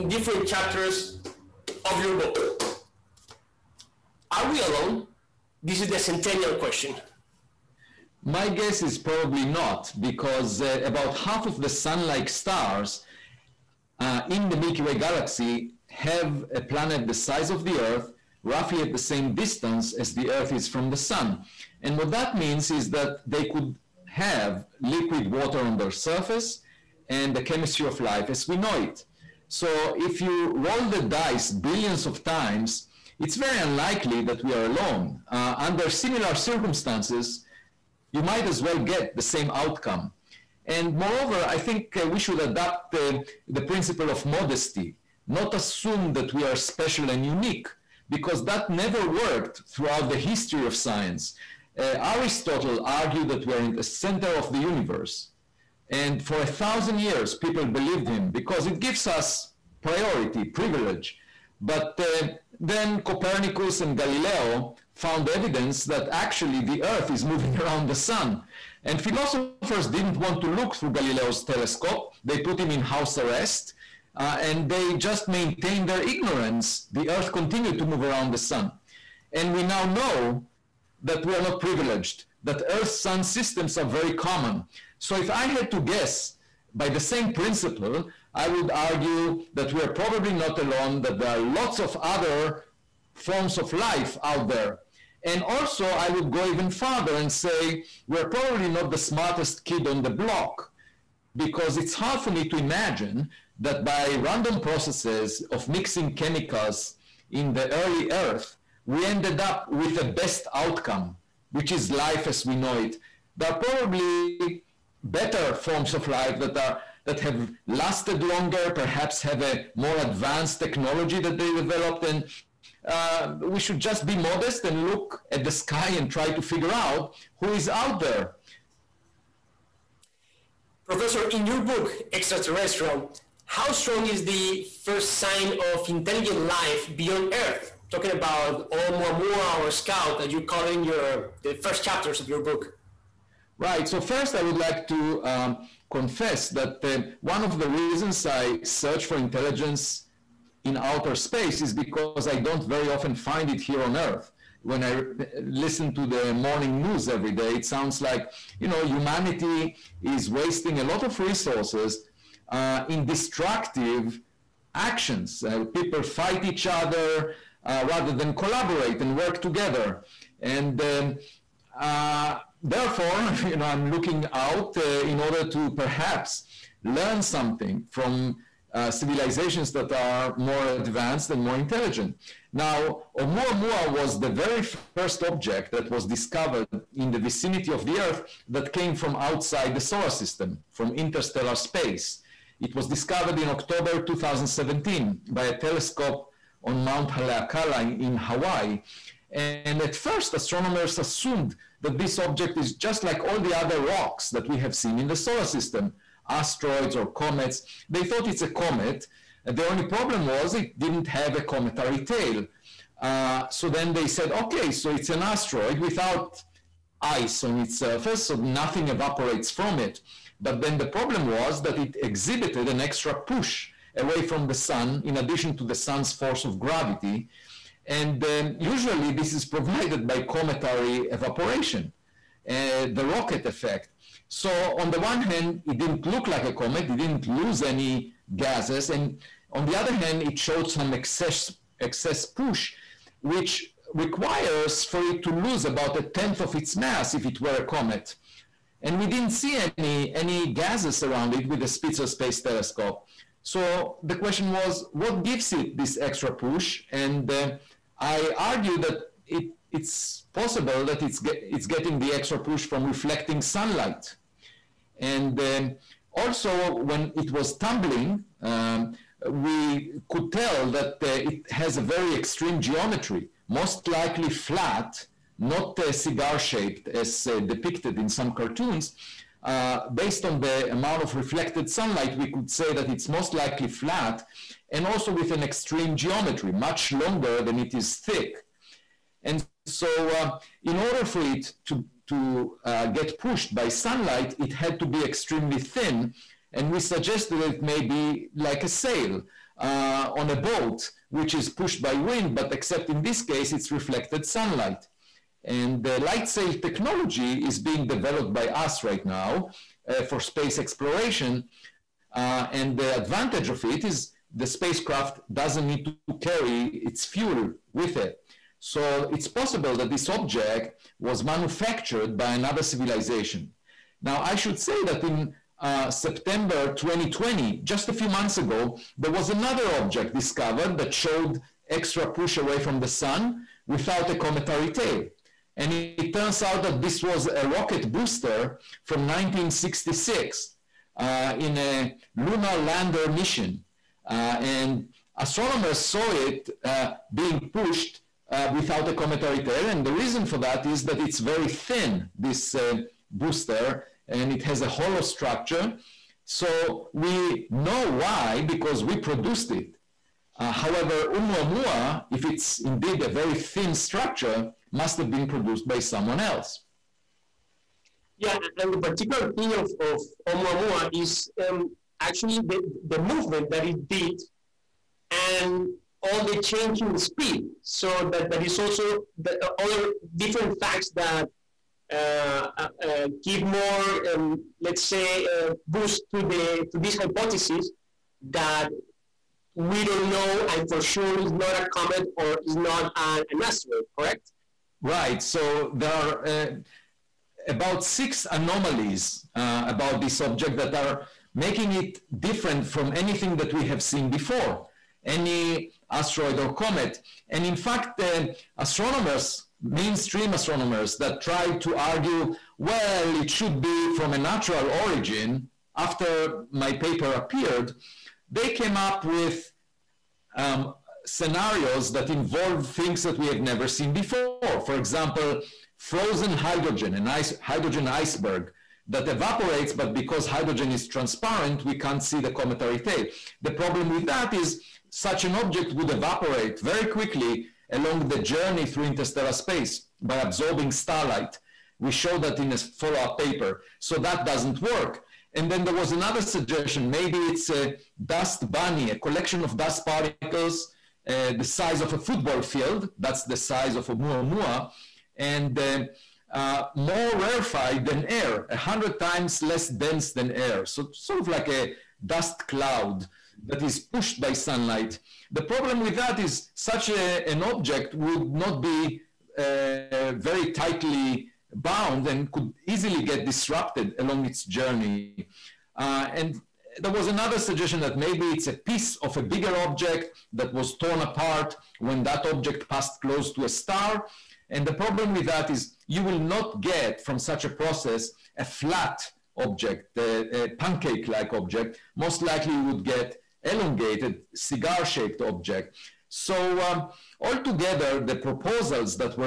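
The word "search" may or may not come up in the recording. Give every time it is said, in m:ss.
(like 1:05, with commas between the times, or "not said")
2:28.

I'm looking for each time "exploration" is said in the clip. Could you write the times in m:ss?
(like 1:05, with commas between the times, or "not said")
5:10.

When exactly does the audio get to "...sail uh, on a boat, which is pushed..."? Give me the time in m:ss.
4:58.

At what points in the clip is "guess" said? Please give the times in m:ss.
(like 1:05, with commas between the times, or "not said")
0:08, 1:25.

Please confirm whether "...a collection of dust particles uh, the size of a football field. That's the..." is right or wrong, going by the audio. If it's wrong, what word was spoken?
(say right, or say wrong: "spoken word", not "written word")
right.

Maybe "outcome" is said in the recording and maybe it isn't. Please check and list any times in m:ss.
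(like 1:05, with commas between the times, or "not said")
0:39, 1:50.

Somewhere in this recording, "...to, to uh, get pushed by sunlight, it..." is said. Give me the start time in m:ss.
4:51.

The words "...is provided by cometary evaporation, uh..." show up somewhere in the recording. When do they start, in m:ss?
3:49.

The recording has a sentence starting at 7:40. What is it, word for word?
So sort of like a dust cloud that is pushed by sunlight.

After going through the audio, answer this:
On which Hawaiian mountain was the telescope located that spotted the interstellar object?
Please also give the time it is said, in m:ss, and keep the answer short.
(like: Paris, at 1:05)
Mount Haleakala, at 3:16.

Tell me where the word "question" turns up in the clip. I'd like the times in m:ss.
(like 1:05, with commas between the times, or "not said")
0:06, 4:14.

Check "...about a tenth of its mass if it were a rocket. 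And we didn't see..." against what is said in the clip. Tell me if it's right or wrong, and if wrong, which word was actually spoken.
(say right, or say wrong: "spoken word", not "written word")
wrong: "comet", not "rocket".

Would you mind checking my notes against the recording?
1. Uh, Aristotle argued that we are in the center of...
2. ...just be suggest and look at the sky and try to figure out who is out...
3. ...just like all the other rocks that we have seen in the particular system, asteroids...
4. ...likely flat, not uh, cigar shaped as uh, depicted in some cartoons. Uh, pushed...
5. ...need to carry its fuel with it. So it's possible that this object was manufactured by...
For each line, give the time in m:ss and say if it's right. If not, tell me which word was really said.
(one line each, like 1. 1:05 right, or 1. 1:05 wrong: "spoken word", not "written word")
1. 0:51 right
2. 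2:03 wrong: "modest", not "suggest"
3. 3:22 wrong: "solar", not "particular"
4. 4:33 wrong: "based", not "pushed"
5. 5:15 right.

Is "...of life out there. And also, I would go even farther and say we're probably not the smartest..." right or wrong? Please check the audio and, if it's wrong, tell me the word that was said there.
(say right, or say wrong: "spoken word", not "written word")
right.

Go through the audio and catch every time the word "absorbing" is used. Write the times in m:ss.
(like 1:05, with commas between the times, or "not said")
7:20.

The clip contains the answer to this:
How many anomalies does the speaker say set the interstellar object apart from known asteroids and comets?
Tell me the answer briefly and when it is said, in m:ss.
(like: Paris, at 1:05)
6, at 6:37.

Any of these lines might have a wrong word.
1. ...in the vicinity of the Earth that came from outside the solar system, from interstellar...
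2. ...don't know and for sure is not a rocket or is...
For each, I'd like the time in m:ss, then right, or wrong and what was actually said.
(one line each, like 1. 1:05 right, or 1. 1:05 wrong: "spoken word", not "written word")
1. 3:06 right
2. 6:29 wrong: "comet", not "rocket".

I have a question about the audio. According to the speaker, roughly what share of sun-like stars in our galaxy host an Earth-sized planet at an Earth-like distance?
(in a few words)
about half.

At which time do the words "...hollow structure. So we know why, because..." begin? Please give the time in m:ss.
5:54.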